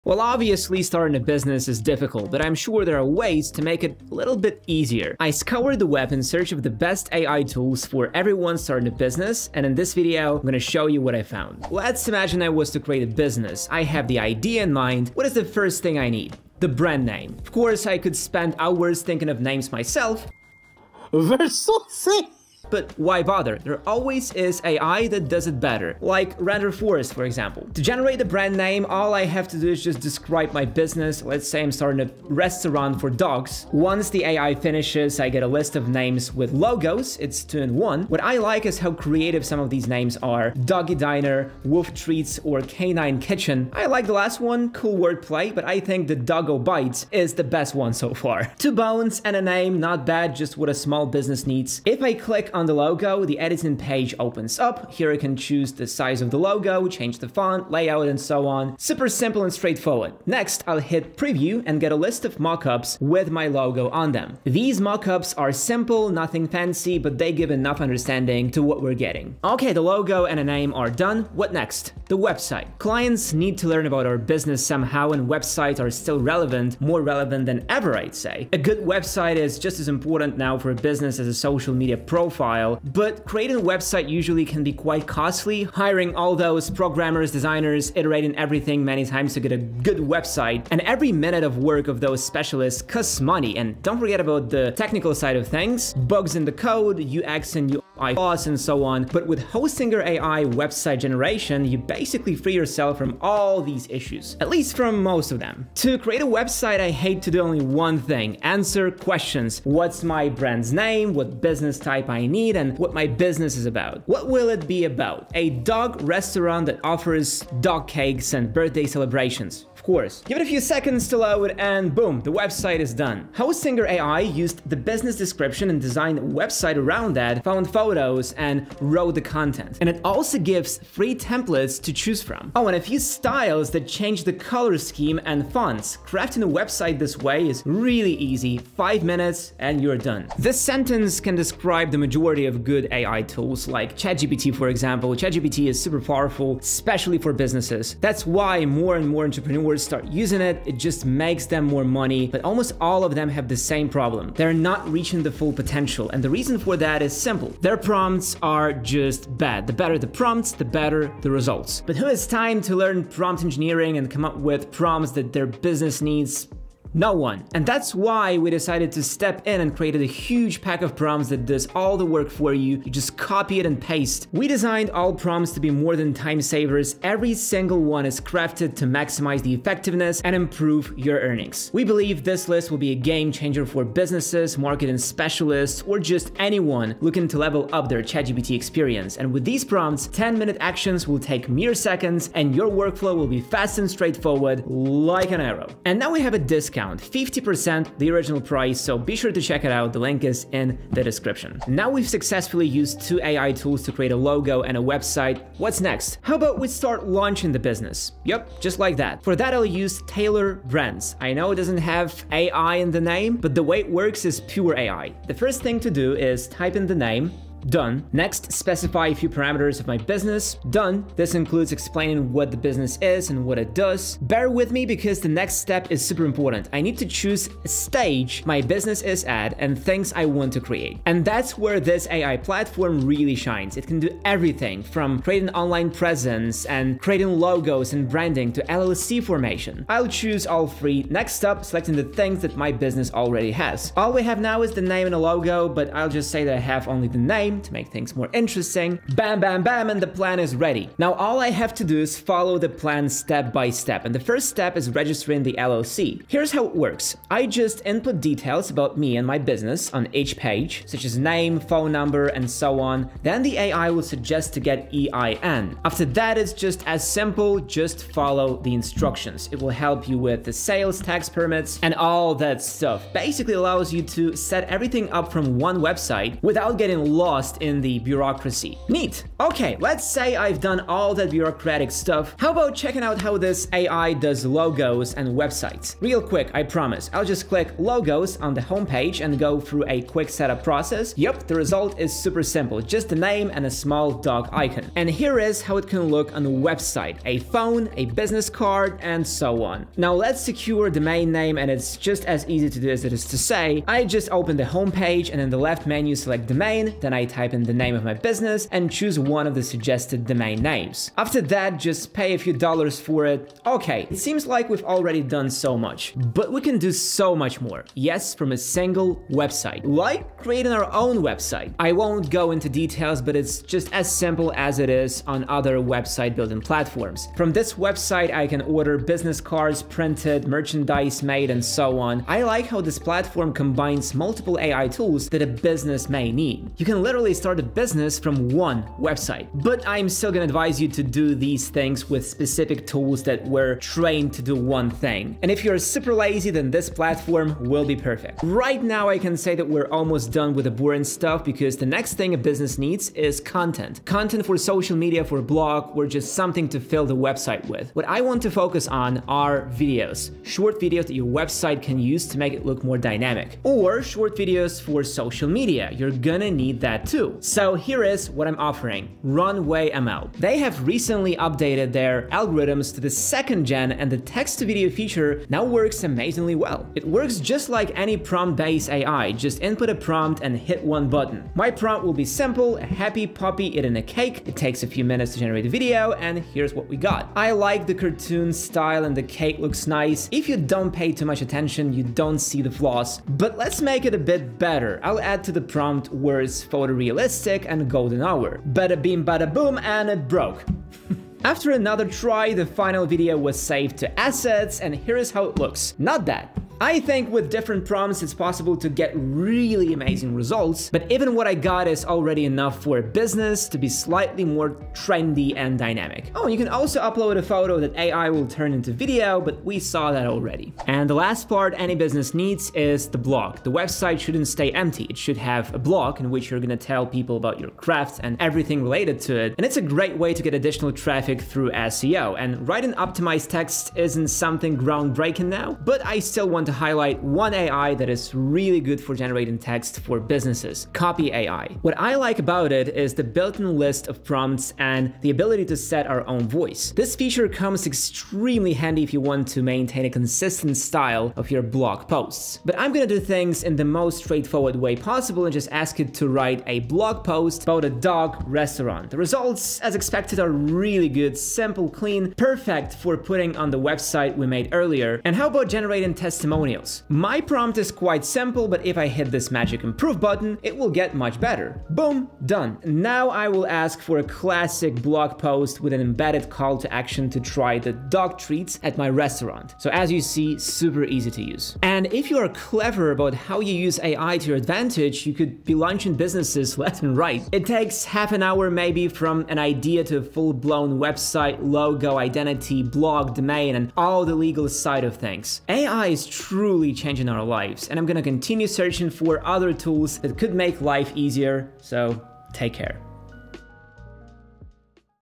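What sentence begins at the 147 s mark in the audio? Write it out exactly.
That's why more and more entrepreneurs start using it.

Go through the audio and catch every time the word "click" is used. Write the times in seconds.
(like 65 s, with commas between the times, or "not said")
52 s, 287 s.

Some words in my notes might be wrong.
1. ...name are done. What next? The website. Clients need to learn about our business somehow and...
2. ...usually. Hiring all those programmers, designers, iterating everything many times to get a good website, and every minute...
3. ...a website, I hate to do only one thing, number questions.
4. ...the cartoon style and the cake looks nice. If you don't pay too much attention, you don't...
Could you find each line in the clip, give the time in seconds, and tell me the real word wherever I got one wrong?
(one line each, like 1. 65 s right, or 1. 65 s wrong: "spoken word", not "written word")
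1. 70 s right
2. 85 s wrong: "costly", not "usually"
3. 106 s wrong: "answer", not "number"
4. 387 s right.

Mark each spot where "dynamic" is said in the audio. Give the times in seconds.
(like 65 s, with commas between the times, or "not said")
362 s, 415 s.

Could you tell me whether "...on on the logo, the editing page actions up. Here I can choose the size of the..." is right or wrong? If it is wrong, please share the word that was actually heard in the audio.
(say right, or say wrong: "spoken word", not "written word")
wrong: "opens", not "actions".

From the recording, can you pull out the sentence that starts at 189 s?
And with these prompts, 10 minute actions will take mere seconds and your workflow will be fast and straightforward like an arrow.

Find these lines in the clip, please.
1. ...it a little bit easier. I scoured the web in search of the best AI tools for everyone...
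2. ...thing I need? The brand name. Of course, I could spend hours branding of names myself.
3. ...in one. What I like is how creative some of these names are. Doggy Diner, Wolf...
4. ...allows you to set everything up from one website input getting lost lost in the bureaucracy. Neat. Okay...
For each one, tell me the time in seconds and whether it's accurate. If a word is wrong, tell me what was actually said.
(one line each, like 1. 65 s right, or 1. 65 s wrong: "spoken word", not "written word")
1. 3 s right
2. 15 s wrong: "thinking", not "branding"
3. 37 s right
4. 273 s wrong: "without", not "input".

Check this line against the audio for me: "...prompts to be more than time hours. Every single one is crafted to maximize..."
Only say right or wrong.
wrong.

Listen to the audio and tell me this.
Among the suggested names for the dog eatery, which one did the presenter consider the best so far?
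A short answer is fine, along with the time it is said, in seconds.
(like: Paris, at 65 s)
Doggo Bites, at 46 s.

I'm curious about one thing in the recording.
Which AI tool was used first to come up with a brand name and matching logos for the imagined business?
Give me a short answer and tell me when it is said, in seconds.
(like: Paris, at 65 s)
Renderforest, at 26 s.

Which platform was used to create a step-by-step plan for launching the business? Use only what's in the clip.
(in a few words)
Tailor Brands.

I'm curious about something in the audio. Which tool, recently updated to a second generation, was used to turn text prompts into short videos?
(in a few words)
Runway ML.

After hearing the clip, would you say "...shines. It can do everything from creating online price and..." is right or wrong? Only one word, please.
wrong.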